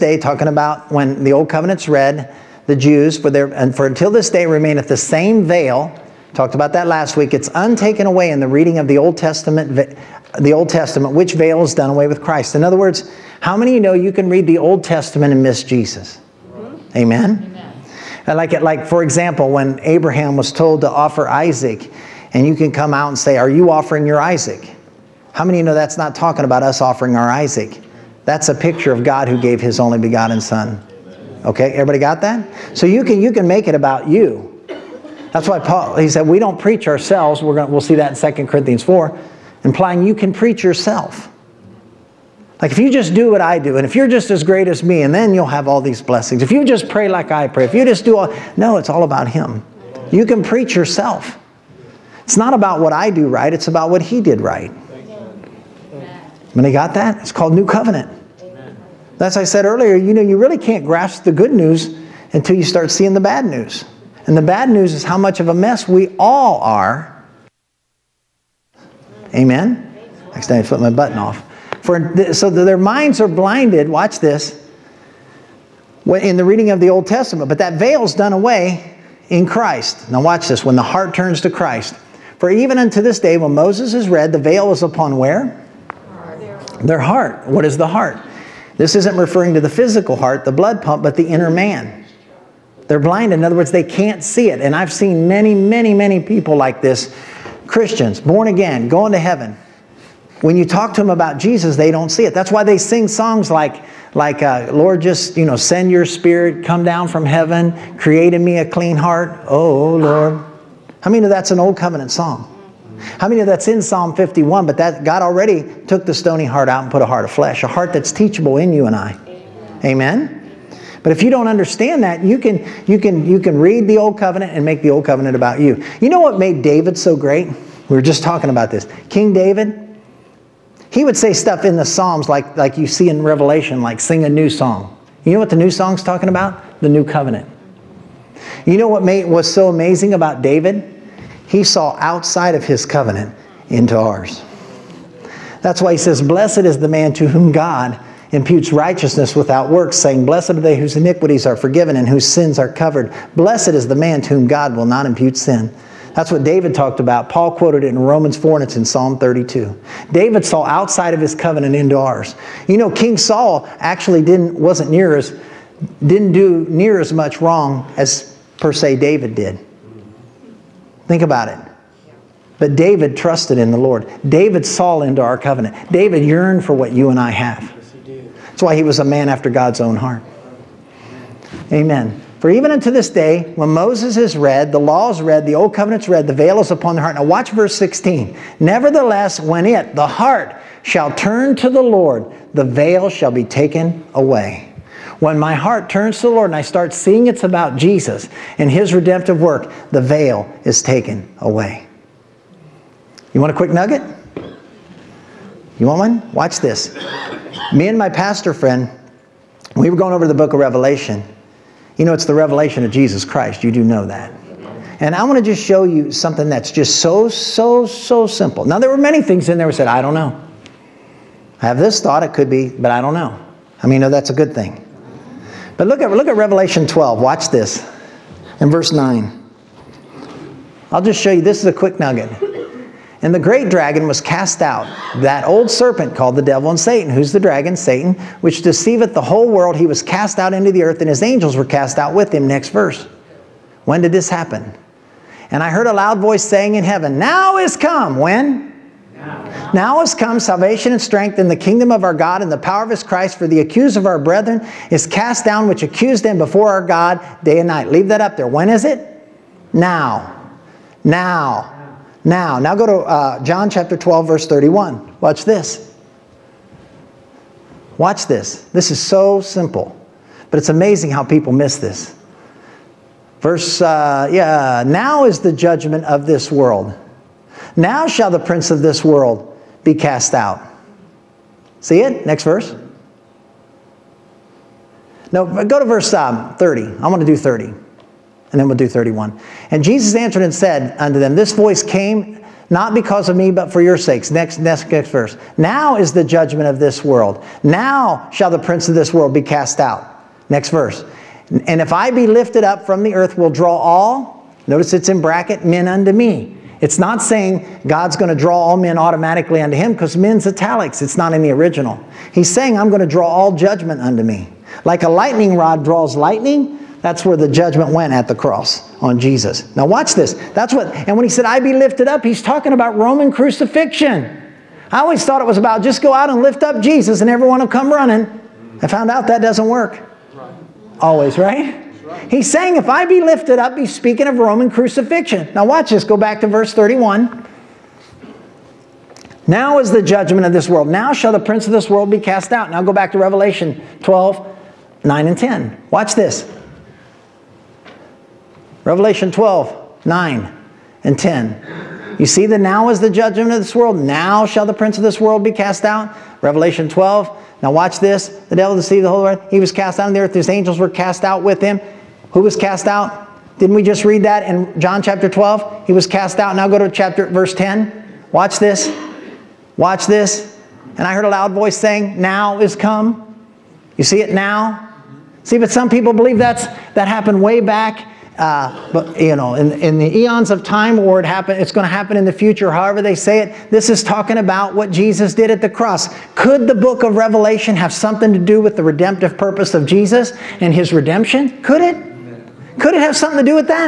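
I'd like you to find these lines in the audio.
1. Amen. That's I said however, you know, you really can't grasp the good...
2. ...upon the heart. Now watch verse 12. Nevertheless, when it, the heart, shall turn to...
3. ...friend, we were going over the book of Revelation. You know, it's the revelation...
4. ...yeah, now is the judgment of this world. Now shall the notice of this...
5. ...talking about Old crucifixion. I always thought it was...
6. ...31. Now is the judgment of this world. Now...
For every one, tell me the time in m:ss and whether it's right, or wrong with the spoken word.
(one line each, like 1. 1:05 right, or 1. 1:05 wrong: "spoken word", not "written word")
1. 0:58 wrong: "earlier", not "however"
2. 3:06 wrong: "16", not "12"
3. 3:28 right
4. 4:34 wrong: "prince", not "notice"
5. 5:22 wrong: "Roman", not "Old"
6. 5:36 right.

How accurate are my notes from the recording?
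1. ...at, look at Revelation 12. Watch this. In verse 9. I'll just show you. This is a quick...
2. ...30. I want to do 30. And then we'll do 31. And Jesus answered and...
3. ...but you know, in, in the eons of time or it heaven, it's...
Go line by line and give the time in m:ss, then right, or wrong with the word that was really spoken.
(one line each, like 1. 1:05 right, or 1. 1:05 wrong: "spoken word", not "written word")
1. 3:46 right
2. 4:46 right
3. 6:18 wrong: "happen", not "heaven".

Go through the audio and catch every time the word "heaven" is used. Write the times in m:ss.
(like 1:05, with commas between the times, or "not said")
1:39, 1:47, 4:06.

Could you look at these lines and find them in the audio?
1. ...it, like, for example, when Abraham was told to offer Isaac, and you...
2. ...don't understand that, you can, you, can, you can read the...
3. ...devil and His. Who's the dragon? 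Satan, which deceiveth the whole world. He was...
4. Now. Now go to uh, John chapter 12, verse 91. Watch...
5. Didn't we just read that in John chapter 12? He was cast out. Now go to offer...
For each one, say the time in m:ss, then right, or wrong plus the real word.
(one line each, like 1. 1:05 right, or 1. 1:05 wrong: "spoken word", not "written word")
1. 0:18 right
2. 2:01 right
3. 3:56 wrong: "Satan", not "His"
4. 4:22 wrong: "31", not "91"
5. 6:03 wrong: "chapter", not "offer".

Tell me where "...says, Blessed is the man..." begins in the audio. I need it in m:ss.
2:25.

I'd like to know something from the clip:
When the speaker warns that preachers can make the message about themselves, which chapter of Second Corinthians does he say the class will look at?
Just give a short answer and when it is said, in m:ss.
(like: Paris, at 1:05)
Second Corinthians 4, at 0:38.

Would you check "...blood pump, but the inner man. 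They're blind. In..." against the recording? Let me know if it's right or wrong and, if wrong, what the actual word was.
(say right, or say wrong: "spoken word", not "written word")
right.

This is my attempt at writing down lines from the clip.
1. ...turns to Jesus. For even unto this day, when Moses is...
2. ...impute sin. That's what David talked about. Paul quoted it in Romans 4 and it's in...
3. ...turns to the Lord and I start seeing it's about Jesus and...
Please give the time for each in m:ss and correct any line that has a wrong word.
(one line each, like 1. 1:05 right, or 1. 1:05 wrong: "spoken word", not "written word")
1. 1:21 wrong: "Christ", not "Jesus"
2. 2:35 right
3. 3:15 right.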